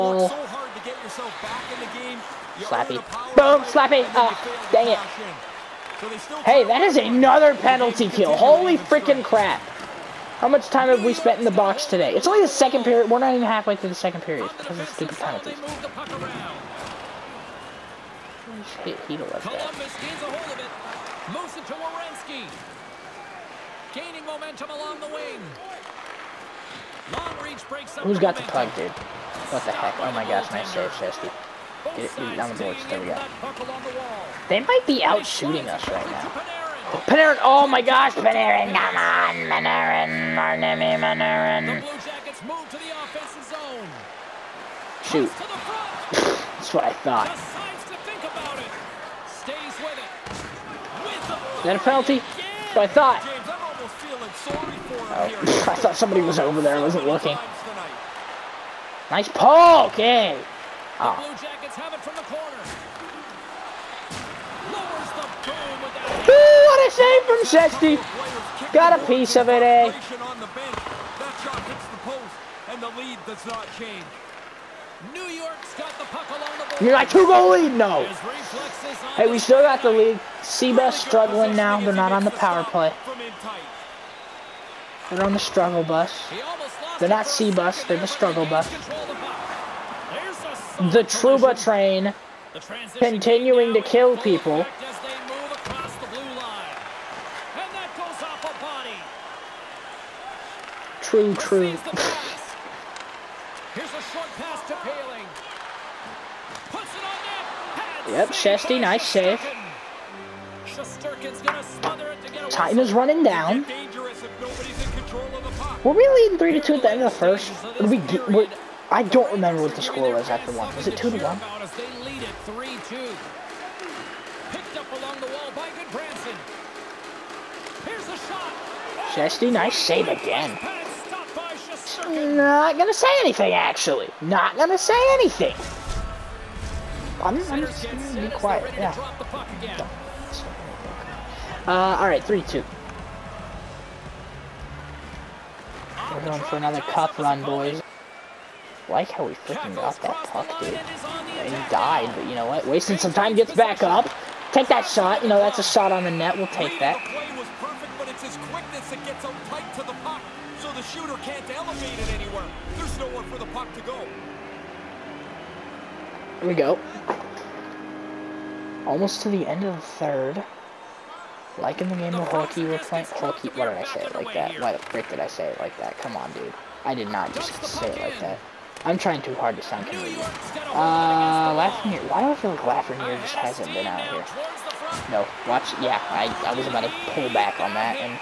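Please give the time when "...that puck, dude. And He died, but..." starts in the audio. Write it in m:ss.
2:30.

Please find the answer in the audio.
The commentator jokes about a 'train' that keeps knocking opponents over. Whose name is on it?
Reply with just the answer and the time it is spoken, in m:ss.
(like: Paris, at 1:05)
Trouba, at 1:31.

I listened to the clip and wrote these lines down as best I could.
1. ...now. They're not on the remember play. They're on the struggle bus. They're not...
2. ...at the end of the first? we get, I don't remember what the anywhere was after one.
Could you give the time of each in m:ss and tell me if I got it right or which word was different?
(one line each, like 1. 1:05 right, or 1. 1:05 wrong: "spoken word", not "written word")
1. 1:21 wrong: "power", not "remember"
2. 1:56 wrong: "score", not "anywhere".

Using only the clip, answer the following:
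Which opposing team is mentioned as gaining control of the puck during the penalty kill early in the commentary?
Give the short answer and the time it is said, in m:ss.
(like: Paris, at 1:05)
Columbus, at 0:19.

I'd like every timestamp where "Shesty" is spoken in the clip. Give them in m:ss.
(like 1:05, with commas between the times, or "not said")
1:07, 1:48, 2:09.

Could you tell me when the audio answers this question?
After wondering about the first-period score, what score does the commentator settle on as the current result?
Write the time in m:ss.
2:22.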